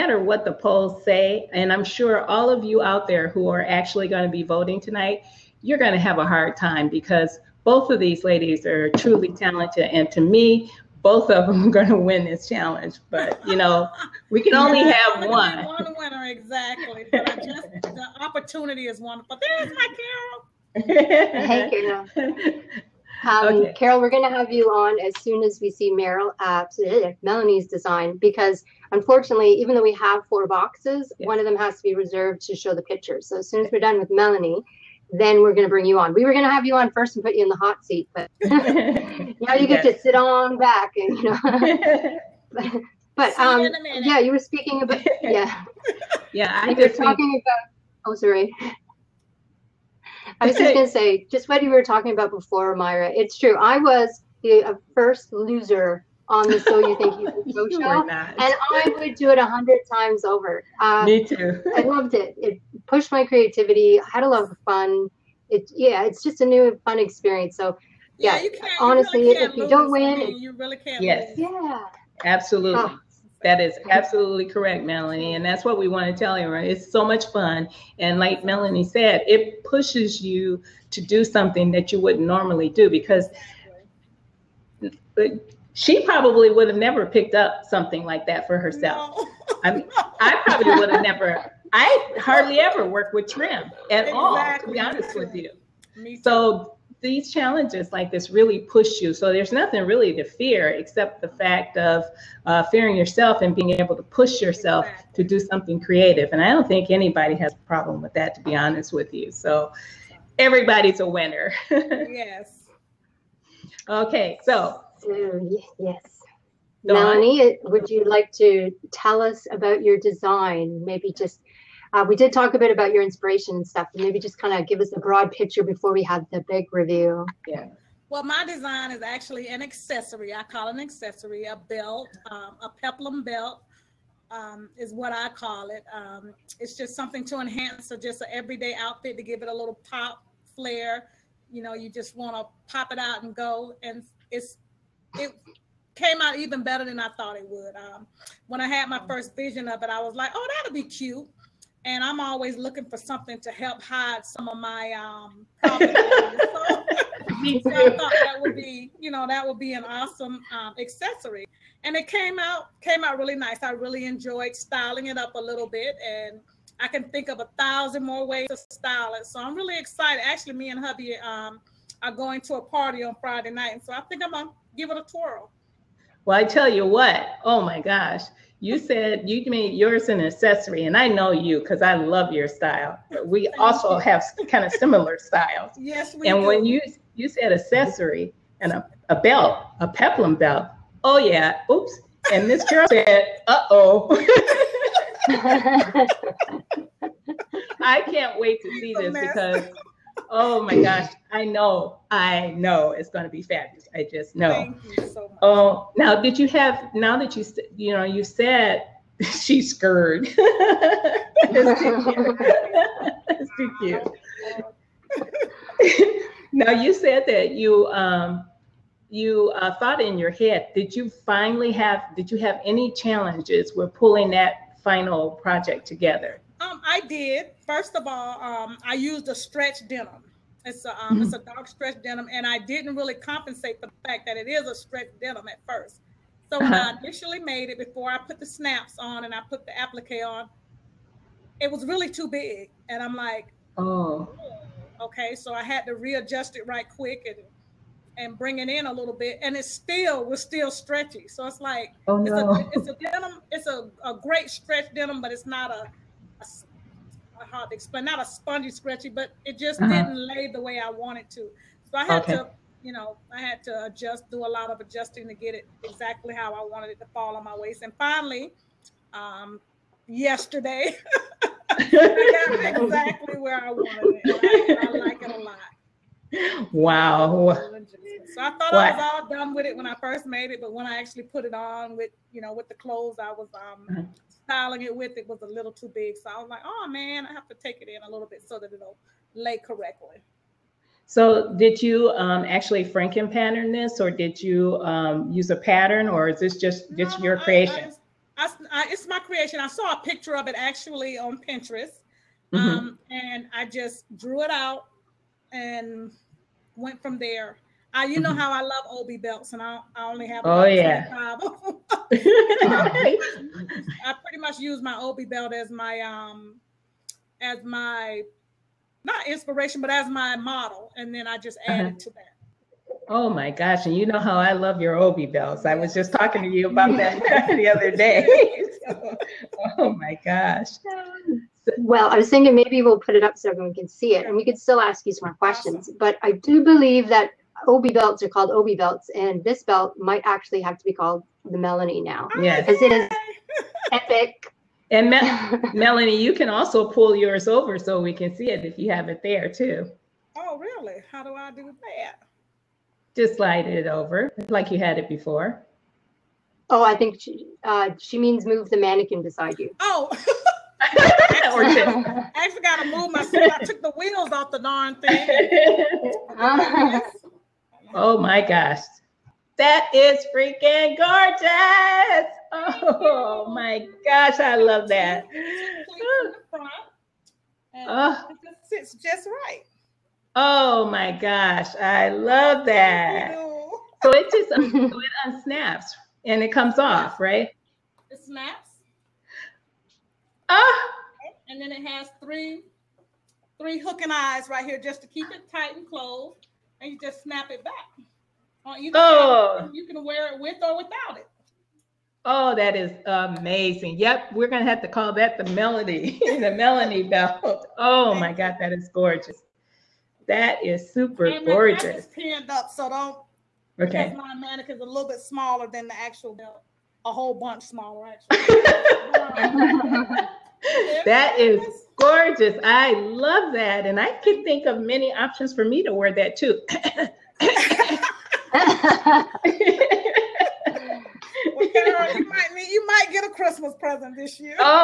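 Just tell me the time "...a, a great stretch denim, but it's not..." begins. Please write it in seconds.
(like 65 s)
253 s.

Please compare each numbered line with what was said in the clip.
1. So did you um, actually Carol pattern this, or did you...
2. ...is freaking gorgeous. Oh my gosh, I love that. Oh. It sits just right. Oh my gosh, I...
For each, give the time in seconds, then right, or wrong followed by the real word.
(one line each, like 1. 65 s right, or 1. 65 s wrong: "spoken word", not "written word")
1. 291 s wrong: "Franken", not "Carol"
2. 369 s right.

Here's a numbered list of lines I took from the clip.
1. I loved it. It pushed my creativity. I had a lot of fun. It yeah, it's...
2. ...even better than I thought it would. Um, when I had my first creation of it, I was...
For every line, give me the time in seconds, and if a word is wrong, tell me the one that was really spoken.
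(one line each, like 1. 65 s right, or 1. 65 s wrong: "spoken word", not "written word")
1. 61 s right
2. 146 s wrong: "vision", not "creation".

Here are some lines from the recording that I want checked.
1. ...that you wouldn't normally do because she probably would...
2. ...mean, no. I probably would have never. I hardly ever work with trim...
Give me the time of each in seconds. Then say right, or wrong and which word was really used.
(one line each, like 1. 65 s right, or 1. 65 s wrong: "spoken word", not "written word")
1. 81 s right
2. 89 s right.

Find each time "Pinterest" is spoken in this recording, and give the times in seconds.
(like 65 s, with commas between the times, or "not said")
301 s.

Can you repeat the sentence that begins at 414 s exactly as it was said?
because my mannequin's a little bit smaller than the actual belt a whole bunch smaller.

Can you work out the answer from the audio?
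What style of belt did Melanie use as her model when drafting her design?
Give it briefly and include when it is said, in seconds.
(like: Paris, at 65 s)
Obi belt, at 314 s.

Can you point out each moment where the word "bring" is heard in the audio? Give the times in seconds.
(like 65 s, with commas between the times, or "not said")
35 s, 248 s.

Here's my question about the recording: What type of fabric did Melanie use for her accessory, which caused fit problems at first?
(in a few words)
dark stretch denim.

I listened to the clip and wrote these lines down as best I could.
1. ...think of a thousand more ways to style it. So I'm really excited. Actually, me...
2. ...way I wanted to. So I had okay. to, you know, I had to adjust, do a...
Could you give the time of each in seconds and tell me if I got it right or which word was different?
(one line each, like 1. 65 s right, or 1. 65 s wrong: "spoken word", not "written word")
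1. 167 s right
2. 260 s right.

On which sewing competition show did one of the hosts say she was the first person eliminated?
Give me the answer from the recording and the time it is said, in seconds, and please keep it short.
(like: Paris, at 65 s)
So You Think You Can Sew, at 56 s.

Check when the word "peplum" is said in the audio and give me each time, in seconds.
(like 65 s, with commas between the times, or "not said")
132 s, 189 s.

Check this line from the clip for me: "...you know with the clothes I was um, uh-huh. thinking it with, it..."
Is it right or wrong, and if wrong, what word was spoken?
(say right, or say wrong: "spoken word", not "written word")
wrong: "styling", not "thinking".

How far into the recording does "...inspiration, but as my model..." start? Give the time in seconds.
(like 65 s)
319 s.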